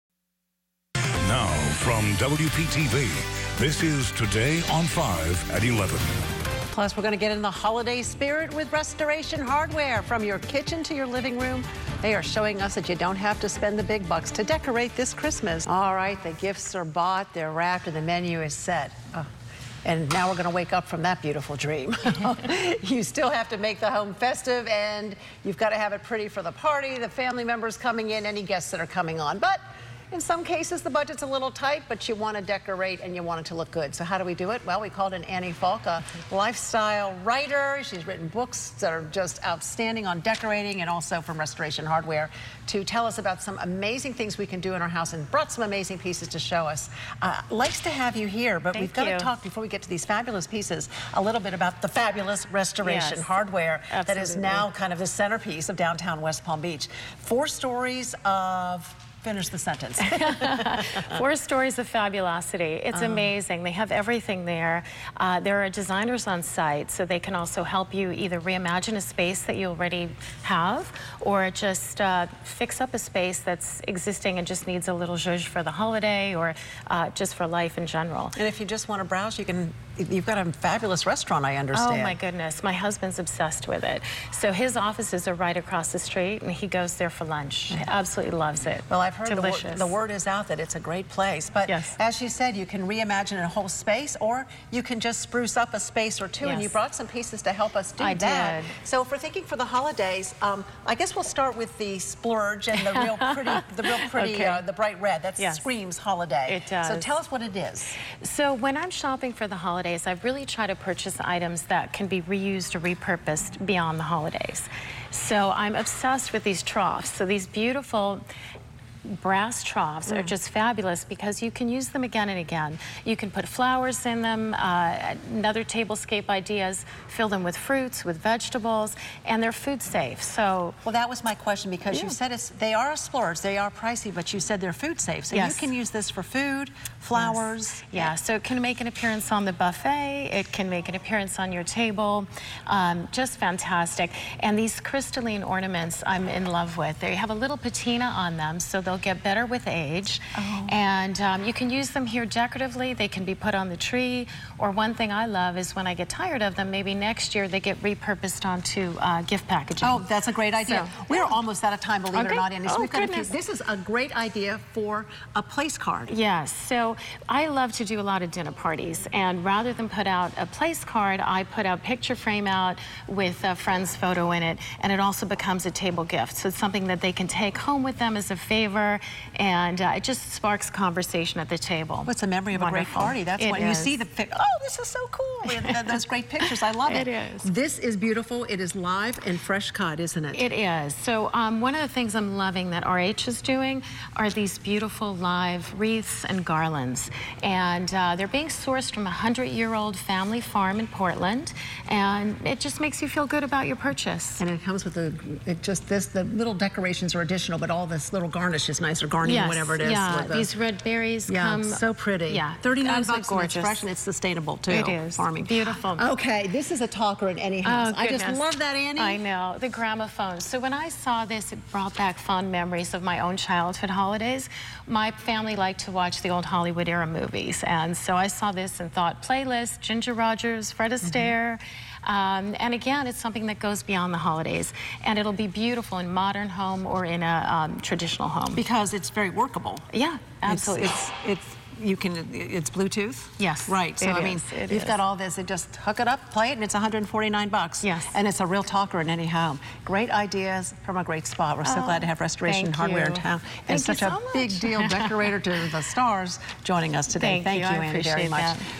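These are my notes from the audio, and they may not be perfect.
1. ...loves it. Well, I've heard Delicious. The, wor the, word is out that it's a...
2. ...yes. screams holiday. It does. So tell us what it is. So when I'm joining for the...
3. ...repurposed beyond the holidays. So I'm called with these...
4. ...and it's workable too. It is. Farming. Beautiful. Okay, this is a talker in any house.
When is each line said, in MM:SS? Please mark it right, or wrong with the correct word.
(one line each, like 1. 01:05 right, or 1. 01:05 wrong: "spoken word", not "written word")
1. 01:28 right
2. 01:45 wrong: "shopping", not "joining"
3. 01:52 wrong: "obsessed", not "called"
4. 03:33 wrong: "sustainable", not "workable".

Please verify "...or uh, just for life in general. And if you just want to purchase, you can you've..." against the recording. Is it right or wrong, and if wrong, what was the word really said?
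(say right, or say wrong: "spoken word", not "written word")
wrong: "browse", not "purchase".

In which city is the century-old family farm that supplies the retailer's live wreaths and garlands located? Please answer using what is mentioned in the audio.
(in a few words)
Portland.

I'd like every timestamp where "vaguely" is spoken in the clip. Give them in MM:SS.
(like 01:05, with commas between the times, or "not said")
not said.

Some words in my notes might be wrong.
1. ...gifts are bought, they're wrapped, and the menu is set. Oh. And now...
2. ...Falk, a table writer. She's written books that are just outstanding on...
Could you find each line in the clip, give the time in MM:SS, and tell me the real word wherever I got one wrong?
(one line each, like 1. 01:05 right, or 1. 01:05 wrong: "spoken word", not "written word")
1. 00:16 right
2. 00:35 wrong: "lifestyle", not "table".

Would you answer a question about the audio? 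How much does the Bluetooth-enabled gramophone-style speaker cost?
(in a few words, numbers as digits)
$149.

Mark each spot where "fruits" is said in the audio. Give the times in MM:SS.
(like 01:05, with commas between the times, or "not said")
02:07.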